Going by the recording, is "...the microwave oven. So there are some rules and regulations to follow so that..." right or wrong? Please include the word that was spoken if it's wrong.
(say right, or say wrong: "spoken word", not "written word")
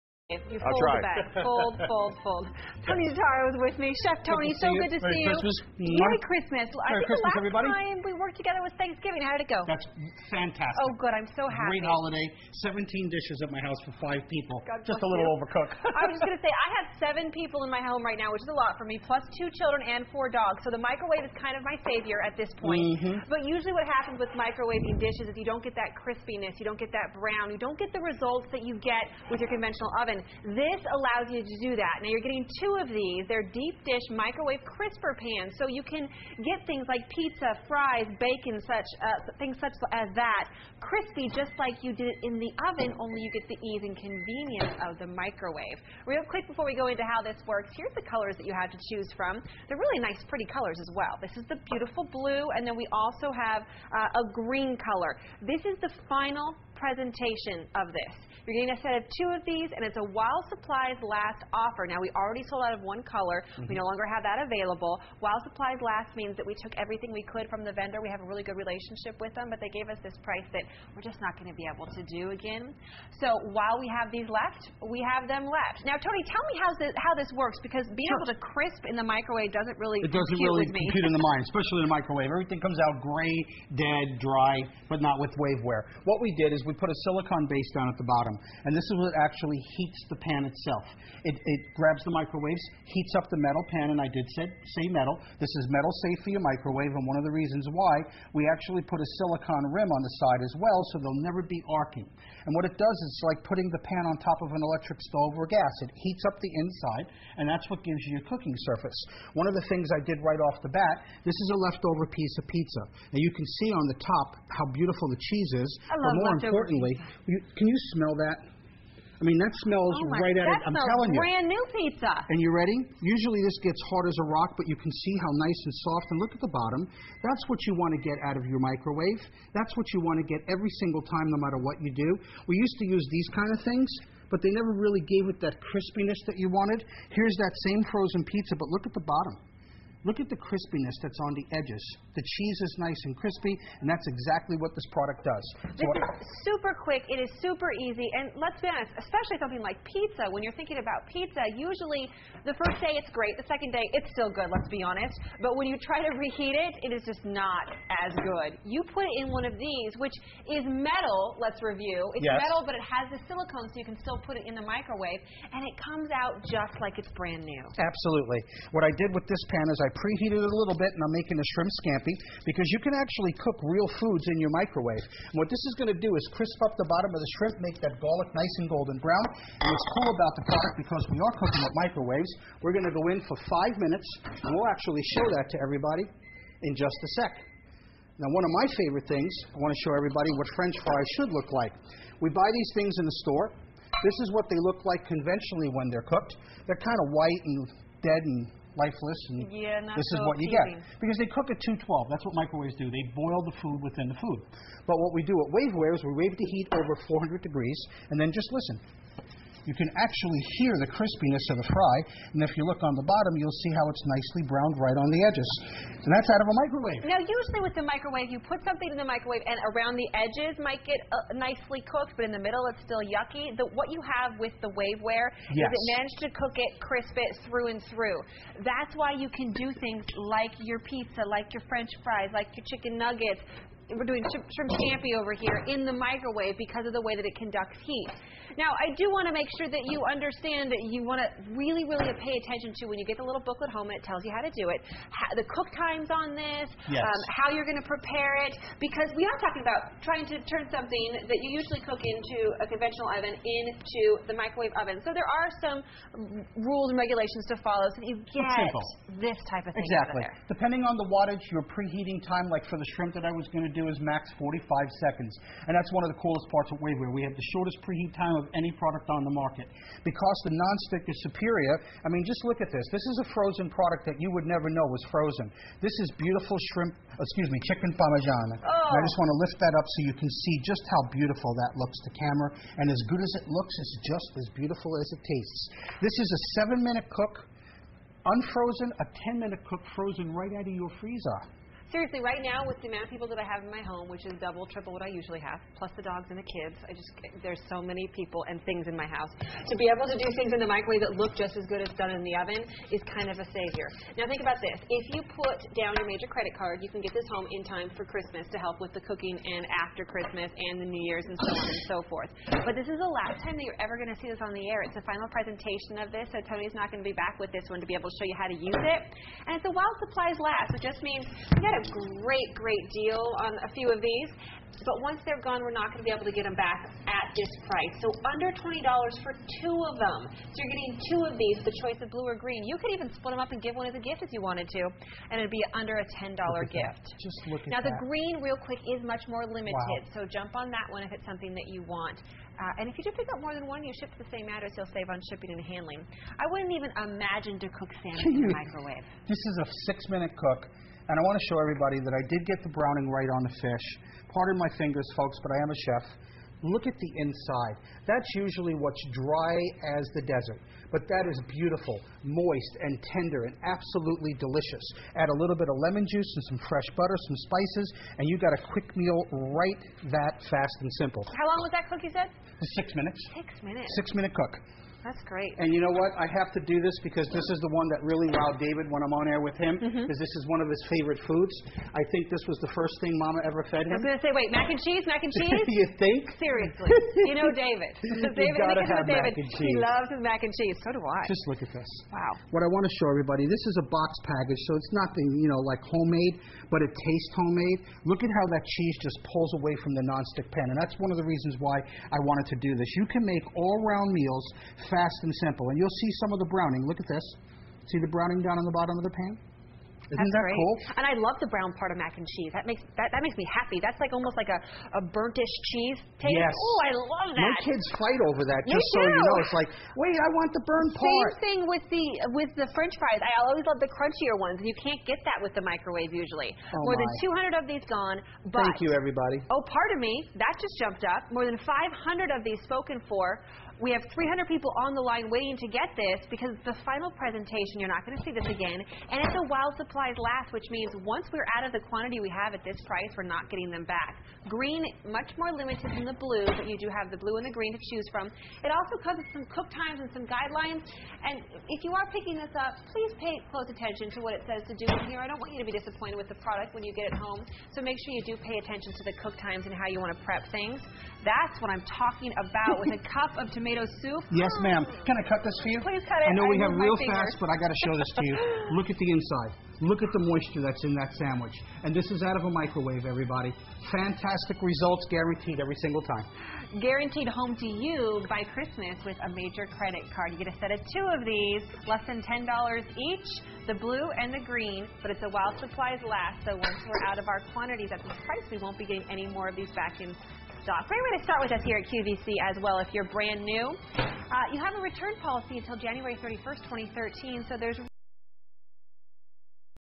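right.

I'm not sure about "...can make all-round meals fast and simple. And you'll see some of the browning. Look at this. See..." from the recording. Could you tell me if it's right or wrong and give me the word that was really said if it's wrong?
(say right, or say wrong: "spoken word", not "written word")
right.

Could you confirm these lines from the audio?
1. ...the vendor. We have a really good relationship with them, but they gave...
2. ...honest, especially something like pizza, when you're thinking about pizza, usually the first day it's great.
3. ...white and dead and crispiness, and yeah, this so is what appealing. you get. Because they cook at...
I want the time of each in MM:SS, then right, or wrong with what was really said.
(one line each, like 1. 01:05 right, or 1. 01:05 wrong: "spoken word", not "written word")
1. 01:07 right
2. 02:28 right
3. 03:17 wrong: "lifeless", not "crispiness".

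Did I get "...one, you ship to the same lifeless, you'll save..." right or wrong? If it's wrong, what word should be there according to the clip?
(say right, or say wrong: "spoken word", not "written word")
wrong: "address", not "lifeless".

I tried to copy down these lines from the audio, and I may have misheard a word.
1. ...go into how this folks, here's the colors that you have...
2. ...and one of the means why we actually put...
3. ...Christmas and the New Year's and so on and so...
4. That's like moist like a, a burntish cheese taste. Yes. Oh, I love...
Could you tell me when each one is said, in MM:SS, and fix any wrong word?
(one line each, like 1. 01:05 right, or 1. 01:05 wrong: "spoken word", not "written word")
1. 00:46 wrong: "works", not "folks"
2. 01:36 wrong: "reasons", not "means"
3. 05:10 right
4. 06:53 wrong: "almost", not "moist".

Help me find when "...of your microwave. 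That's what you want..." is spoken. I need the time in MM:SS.
02:08.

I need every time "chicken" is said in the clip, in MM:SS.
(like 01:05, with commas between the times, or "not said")
03:52, 04:37.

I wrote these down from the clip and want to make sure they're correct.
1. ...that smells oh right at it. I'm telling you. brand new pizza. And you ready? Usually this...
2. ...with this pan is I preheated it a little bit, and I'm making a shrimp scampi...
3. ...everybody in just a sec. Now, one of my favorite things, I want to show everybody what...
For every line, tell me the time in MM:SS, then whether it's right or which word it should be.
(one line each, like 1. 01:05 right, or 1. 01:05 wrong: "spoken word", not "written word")
1. 01:59 right
2. 02:49 right
3. 03:05 right.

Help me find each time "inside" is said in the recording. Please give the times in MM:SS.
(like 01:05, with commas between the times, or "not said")
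01:46, 05:57, 07:49.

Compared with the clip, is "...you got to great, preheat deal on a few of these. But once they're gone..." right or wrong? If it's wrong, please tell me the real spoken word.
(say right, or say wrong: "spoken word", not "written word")
wrong: "great", not "preheat".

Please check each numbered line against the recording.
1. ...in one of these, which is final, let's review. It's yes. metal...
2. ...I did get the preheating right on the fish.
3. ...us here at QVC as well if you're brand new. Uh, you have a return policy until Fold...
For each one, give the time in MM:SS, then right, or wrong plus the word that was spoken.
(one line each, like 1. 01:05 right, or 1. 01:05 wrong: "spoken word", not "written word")
1. 02:39 wrong: "metal", not "final"
2. 05:52 wrong: "browning", not "preheating"
3. 08:11 wrong: "January", not "Fold".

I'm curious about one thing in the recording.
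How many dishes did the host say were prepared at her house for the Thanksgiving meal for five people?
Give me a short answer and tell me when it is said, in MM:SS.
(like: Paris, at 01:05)
17, at 00:12.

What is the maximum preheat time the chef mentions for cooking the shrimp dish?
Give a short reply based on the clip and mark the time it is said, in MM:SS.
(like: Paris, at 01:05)
45 seconds, at 04:24.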